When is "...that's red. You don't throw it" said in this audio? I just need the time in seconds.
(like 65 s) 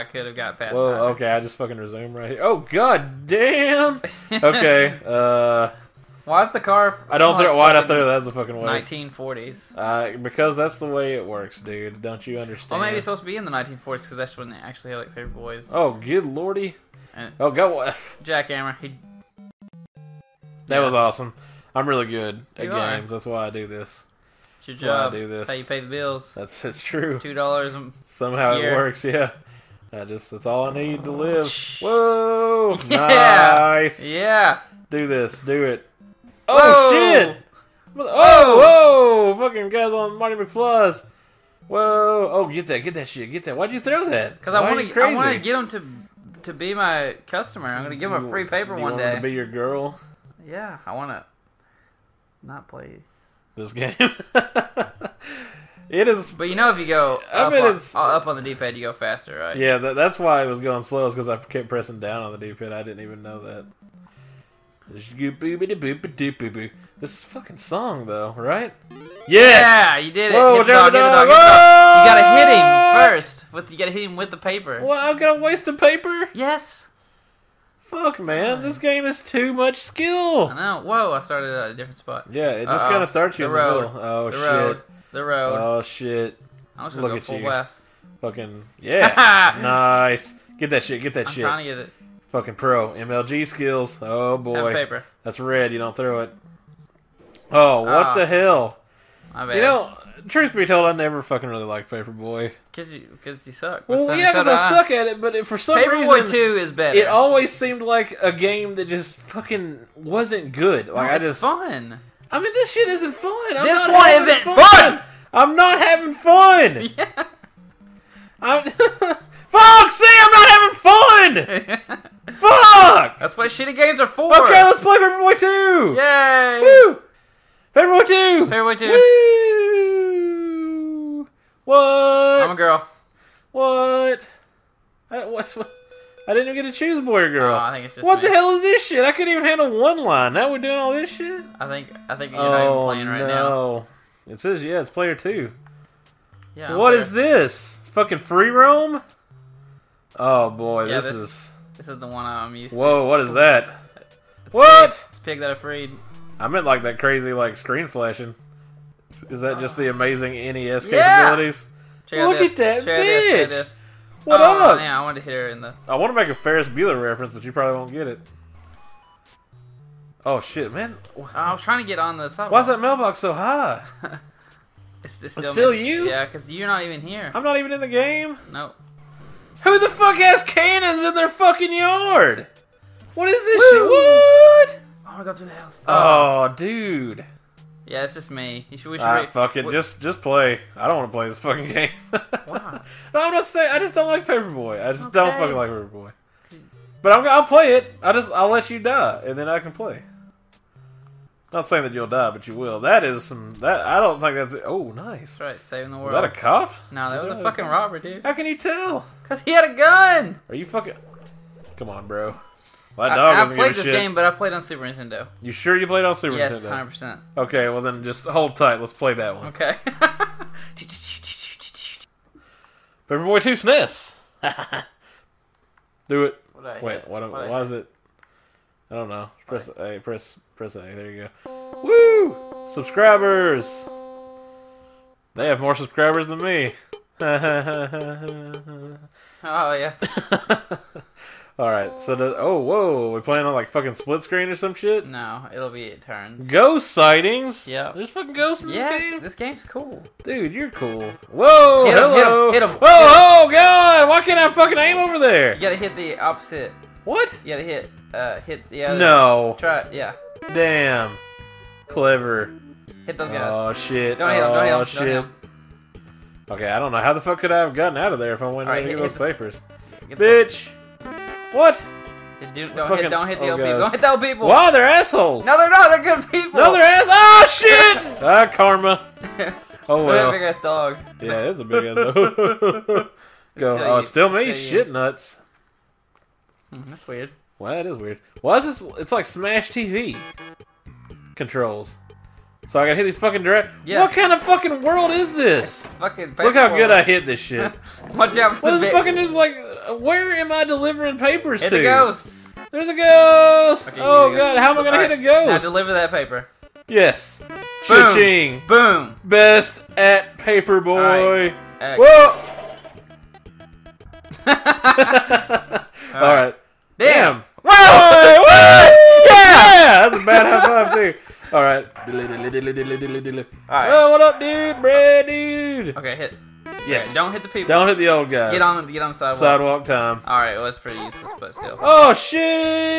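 95 s.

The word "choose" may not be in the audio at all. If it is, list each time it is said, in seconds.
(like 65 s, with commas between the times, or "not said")
136 s.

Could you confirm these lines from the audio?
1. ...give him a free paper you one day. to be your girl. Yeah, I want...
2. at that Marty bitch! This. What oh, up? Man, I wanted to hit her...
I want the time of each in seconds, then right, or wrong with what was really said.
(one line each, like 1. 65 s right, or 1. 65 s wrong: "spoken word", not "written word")
1. 47 s right
2. 162 s wrong: "Check", not "Marty".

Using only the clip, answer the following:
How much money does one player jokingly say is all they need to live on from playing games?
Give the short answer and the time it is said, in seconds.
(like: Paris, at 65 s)
$2, at 27 s.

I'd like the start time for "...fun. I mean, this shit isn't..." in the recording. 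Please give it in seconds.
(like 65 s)
111 s.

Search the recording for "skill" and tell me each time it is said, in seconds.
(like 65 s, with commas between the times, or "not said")
79 s, 93 s.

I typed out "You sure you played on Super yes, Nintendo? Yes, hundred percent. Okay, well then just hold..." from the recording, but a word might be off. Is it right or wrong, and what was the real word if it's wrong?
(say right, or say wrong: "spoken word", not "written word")
right.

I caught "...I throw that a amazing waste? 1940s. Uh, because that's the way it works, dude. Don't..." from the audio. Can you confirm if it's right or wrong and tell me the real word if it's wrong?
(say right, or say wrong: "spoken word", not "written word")
wrong: "fucking", not "amazing".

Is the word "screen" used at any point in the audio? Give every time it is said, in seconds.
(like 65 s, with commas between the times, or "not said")
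157 s, 244 s.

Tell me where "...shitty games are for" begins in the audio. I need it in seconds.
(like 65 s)
123 s.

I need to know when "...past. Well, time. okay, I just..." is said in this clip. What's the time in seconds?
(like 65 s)
0 s.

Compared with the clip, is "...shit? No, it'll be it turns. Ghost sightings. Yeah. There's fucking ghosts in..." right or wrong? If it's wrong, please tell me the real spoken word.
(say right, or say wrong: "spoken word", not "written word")
right.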